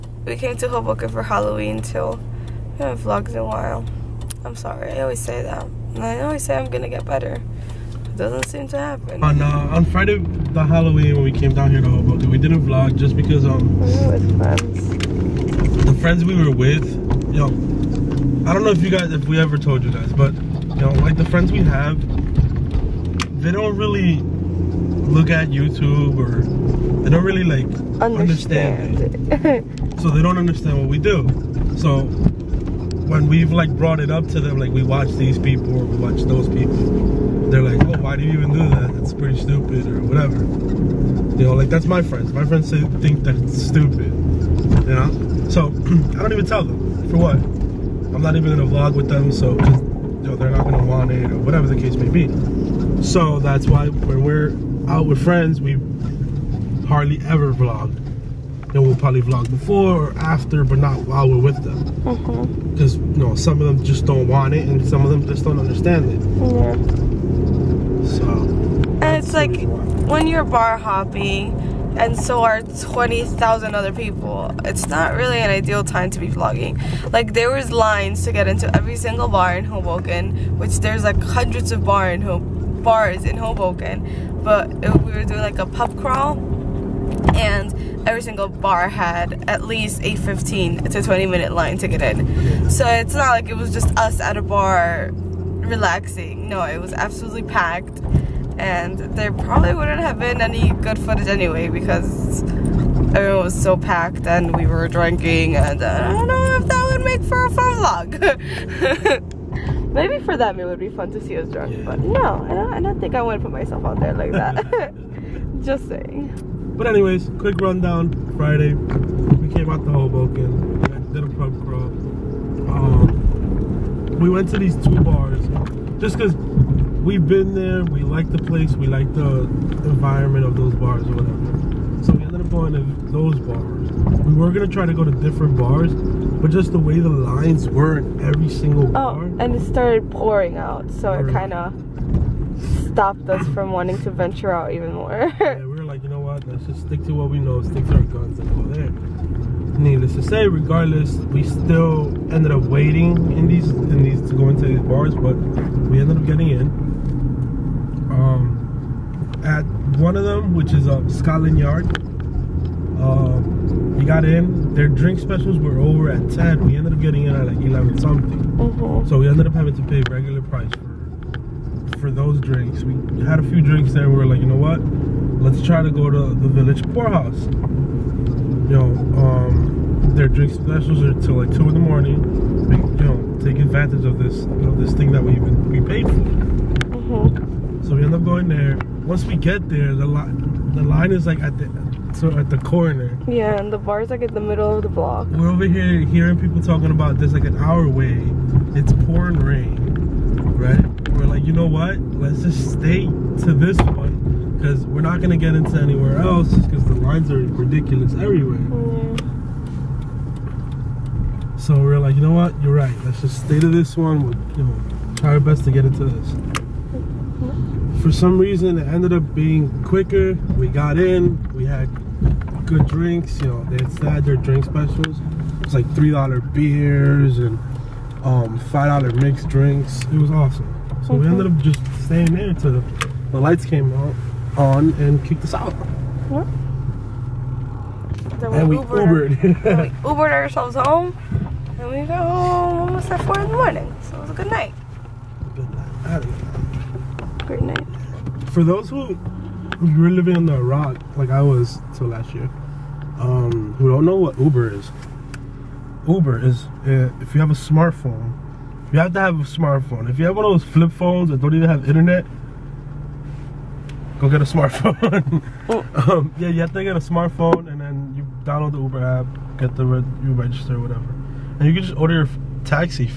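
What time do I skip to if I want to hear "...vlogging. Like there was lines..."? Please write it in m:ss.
1:16.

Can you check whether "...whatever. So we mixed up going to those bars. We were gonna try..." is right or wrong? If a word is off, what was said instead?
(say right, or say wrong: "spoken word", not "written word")
wrong: "ended", not "mixed".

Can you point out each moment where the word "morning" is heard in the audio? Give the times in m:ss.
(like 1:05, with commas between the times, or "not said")
3:01, 4:03.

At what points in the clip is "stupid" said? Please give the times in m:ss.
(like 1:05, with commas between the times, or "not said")
0:39, 0:43.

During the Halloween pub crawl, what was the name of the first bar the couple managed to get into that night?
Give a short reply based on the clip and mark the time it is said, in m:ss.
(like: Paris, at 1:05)
Scotland Yard, at 2:41.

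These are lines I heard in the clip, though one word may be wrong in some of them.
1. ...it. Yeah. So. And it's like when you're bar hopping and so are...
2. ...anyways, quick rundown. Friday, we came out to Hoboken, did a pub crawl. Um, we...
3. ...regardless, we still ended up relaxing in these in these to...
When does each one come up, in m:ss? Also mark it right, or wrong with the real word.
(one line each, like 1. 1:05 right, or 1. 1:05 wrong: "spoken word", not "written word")
1. 1:06 right
2. 1:56 right
3. 2:30 wrong: "waiting", not "relaxing".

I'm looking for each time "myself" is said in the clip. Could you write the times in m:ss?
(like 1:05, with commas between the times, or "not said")
1:53.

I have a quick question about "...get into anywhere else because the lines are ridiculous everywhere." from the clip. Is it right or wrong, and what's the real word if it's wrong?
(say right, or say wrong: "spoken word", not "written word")
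right.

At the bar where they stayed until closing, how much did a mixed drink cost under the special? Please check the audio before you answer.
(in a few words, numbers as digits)
$5.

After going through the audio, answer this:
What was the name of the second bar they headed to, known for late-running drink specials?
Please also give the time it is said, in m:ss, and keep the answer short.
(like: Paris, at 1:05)
Village Pourhouse, at 2:56.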